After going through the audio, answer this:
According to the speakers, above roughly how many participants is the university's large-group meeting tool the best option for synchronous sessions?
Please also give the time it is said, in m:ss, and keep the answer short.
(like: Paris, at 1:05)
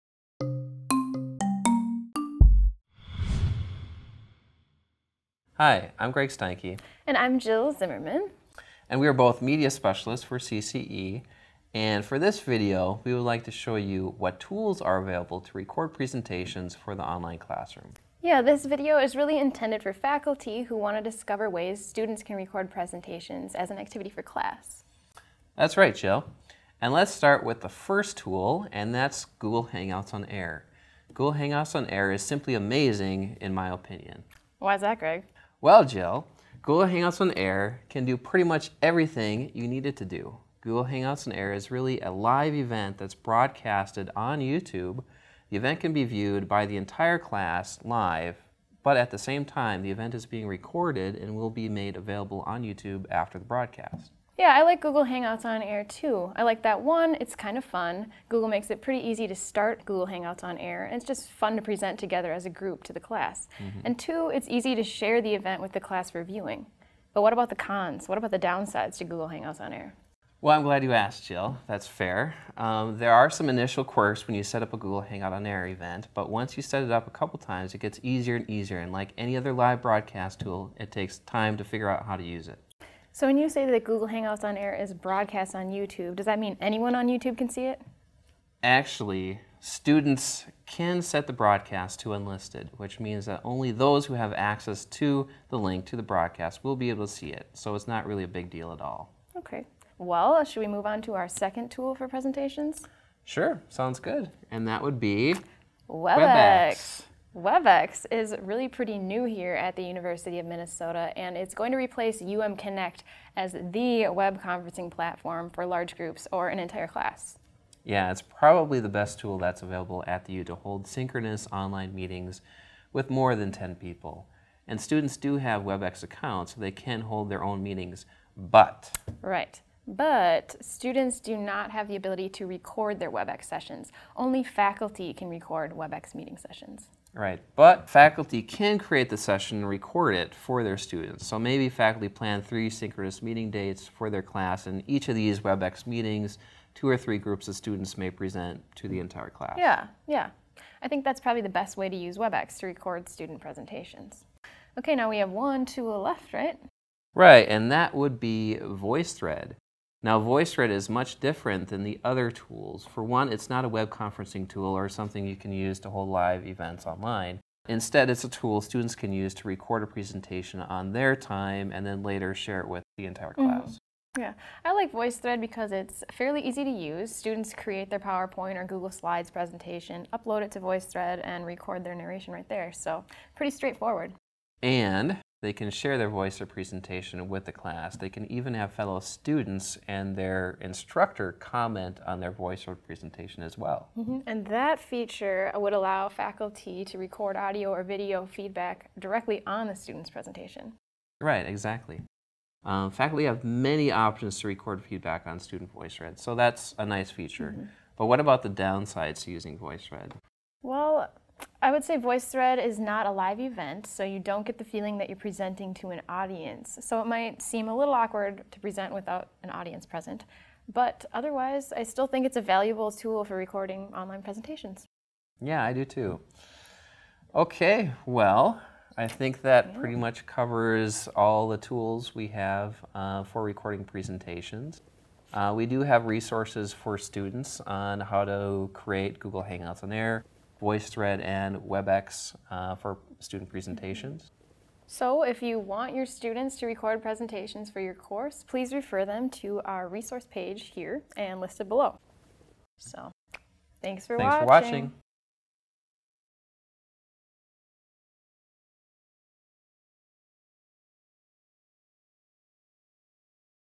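10, at 2:03.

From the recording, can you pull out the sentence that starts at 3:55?
Uh, we do have resources for students on how to create Google Hangouts on Air.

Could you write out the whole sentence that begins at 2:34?
Okay, now we have one tool left, right?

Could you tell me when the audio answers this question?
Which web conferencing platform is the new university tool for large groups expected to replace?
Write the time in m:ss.
1:52.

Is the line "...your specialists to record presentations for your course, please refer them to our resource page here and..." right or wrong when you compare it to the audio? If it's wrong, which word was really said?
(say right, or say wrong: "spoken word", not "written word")
wrong: "students", not "specialists".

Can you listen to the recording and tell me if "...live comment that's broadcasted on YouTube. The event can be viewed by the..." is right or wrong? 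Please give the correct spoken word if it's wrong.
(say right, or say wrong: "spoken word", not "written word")
wrong: "event", not "comment".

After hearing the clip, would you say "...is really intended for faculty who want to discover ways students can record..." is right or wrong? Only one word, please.
right.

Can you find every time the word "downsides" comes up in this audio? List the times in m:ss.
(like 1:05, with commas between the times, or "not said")
1:08, 3:28.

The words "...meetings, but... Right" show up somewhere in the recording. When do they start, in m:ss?
2:07.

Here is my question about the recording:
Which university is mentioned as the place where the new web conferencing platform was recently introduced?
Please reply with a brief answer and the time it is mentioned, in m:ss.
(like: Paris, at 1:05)
University of Minnesota, at 1:49.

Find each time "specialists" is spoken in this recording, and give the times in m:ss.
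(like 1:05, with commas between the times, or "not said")
0:09.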